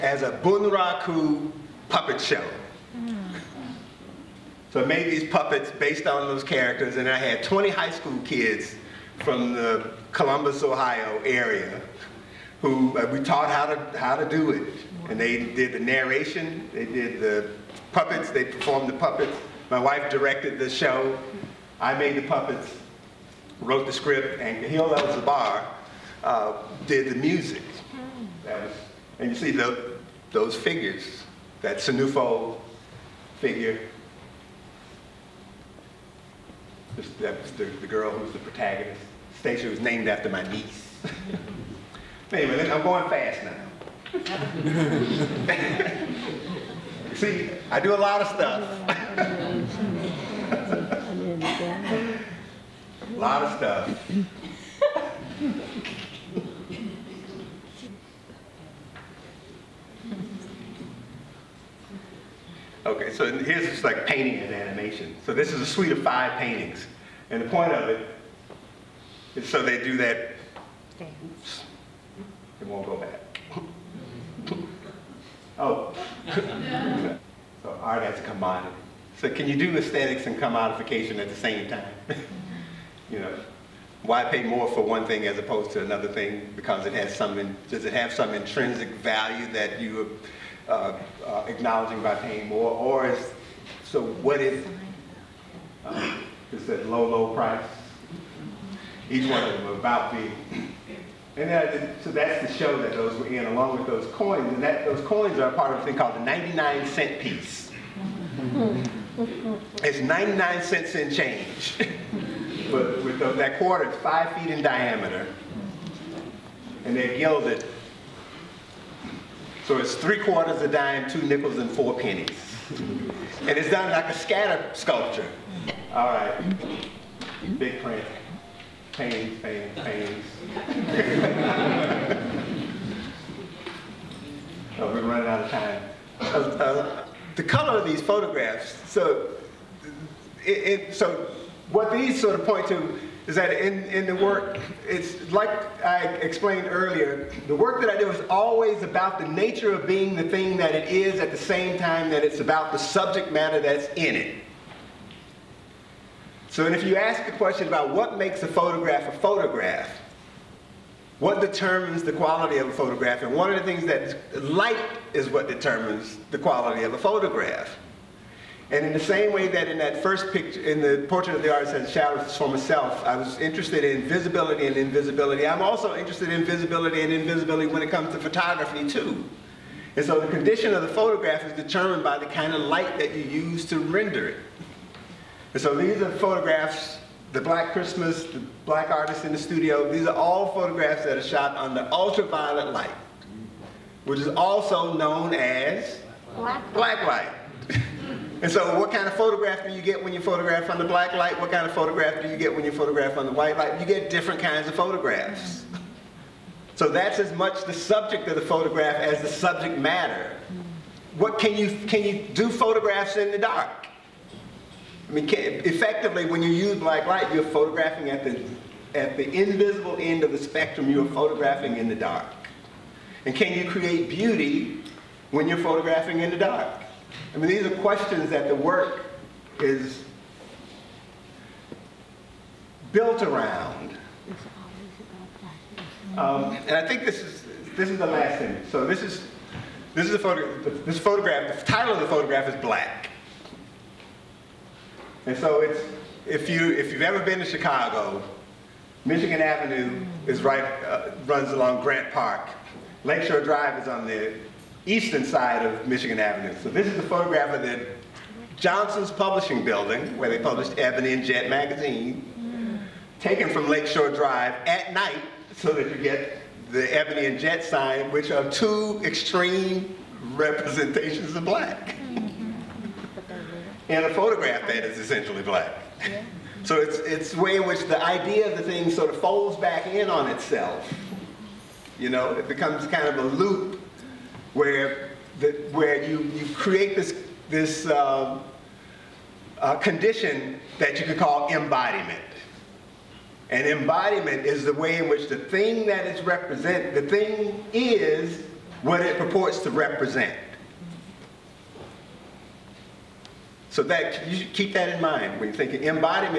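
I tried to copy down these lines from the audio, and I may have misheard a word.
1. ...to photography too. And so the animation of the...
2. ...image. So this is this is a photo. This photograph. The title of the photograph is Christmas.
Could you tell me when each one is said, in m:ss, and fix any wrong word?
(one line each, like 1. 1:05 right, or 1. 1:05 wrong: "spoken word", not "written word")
1. 2:58 wrong: "condition", not "animation"
2. 3:58 wrong: "Black", not "Christmas".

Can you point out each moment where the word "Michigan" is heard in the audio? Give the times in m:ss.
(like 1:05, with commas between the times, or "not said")
4:09, 4:15.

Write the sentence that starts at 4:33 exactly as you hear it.
and a photograph that is essentially black.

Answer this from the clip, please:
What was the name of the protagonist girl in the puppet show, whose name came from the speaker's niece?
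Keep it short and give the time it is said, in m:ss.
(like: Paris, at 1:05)
Stacia, at 0:39.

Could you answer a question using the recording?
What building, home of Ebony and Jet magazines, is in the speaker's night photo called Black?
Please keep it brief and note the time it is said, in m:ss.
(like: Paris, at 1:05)
Johnson's Publishing Building, at 4:18.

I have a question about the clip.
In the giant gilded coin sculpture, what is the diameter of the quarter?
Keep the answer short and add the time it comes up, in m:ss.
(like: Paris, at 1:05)
5 feet, at 1:53.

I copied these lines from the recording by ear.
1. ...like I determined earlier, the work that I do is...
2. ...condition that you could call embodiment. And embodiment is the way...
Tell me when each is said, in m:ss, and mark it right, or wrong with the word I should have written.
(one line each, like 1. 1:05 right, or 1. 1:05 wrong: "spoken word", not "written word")
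1. 2:25 wrong: "explained", not "determined"
2. 4:49 right.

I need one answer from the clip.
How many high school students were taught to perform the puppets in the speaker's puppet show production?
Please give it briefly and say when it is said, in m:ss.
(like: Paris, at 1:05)
20, at 0:07.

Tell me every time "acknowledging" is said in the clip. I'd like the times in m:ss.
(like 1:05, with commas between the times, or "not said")
1:31.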